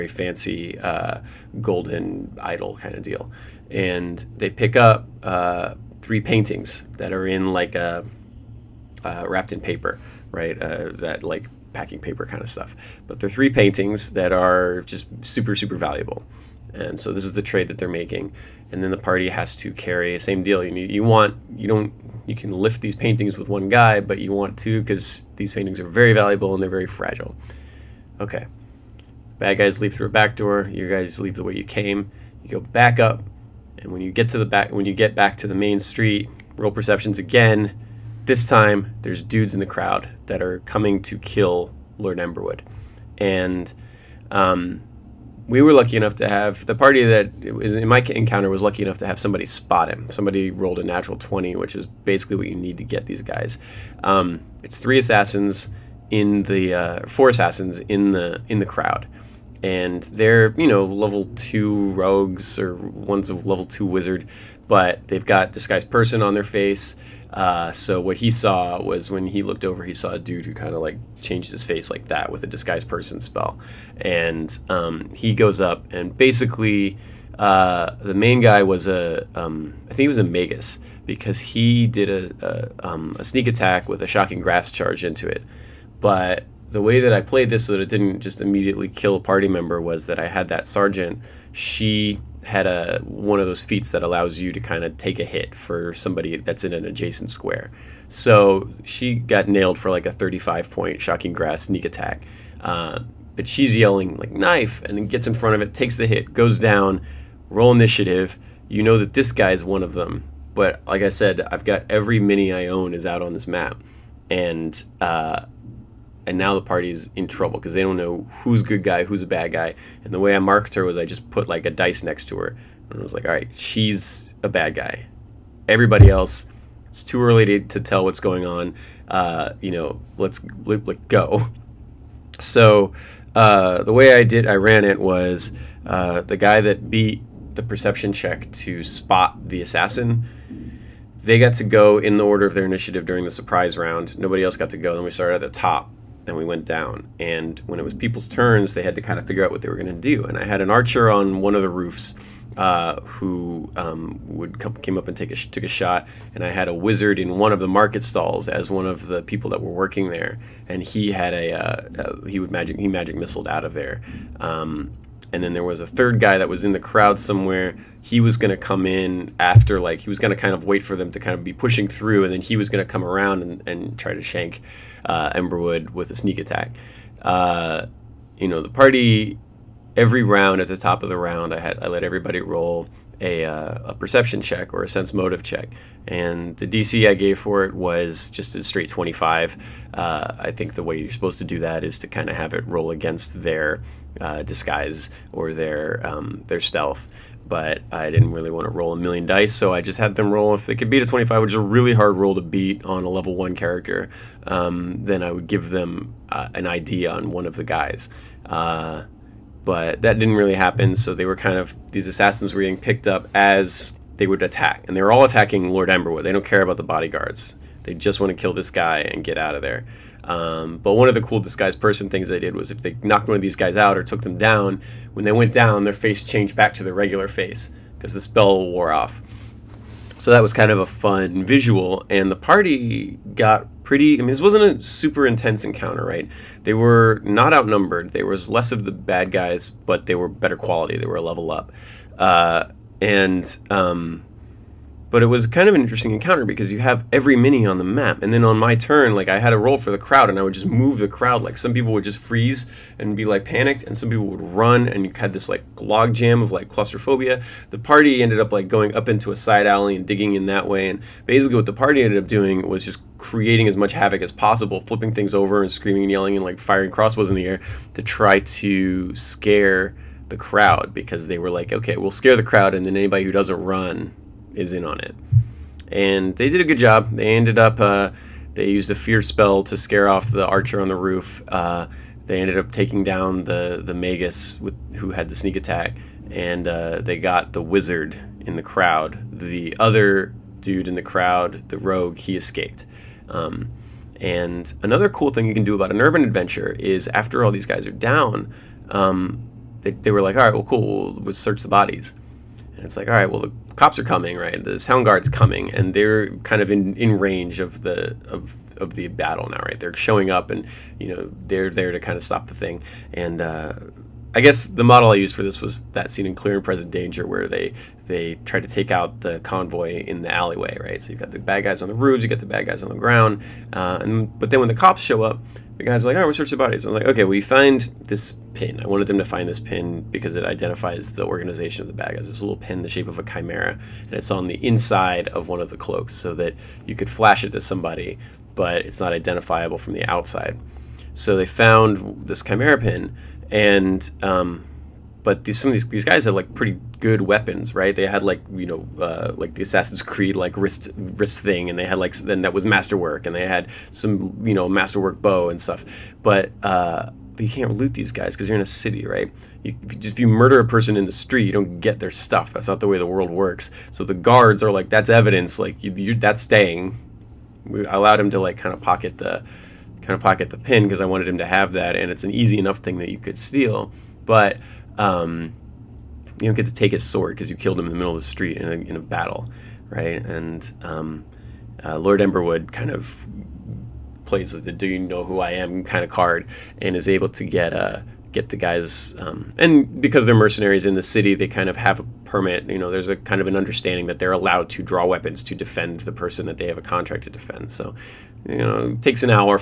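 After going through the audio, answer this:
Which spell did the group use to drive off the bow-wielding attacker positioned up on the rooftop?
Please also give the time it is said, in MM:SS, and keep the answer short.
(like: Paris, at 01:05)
Fear, at 04:38.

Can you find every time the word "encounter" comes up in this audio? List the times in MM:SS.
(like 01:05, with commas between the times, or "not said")
00:48, 03:55, 04:06.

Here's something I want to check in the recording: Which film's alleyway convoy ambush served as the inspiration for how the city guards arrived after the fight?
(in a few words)
Clear and Present Danger.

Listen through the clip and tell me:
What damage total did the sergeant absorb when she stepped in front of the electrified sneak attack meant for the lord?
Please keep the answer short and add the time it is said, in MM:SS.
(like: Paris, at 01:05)
35, at 01:40.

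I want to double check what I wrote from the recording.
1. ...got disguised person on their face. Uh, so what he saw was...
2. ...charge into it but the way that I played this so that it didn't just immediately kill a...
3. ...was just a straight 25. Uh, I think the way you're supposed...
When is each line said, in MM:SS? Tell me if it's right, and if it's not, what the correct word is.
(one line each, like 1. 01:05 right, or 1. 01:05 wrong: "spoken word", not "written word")
1. 01:05 right
2. 01:24 right
3. 03:07 right.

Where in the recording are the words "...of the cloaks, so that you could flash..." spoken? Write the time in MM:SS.
05:35.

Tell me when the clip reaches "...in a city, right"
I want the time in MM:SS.
05:58.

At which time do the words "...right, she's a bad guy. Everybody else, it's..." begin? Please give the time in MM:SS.
02:03.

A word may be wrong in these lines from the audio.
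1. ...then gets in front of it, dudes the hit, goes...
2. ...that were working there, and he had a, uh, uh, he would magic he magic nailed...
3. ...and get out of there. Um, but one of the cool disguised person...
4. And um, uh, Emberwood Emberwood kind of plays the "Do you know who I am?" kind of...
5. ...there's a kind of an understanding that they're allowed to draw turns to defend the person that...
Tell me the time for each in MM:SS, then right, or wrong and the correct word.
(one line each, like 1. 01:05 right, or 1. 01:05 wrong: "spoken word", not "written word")
1. 01:44 wrong: "takes", not "dudes"
2. 02:39 wrong: "missiled", not "nailed"
3. 03:38 right
4. 06:20 wrong: "Lord", not "Emberwood"
5. 06:32 wrong: "weapons", not "turns".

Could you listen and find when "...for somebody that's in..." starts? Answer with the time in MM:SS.
01:35.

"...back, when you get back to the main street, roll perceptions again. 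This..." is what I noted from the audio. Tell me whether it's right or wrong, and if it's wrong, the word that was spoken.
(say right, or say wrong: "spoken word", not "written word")
right.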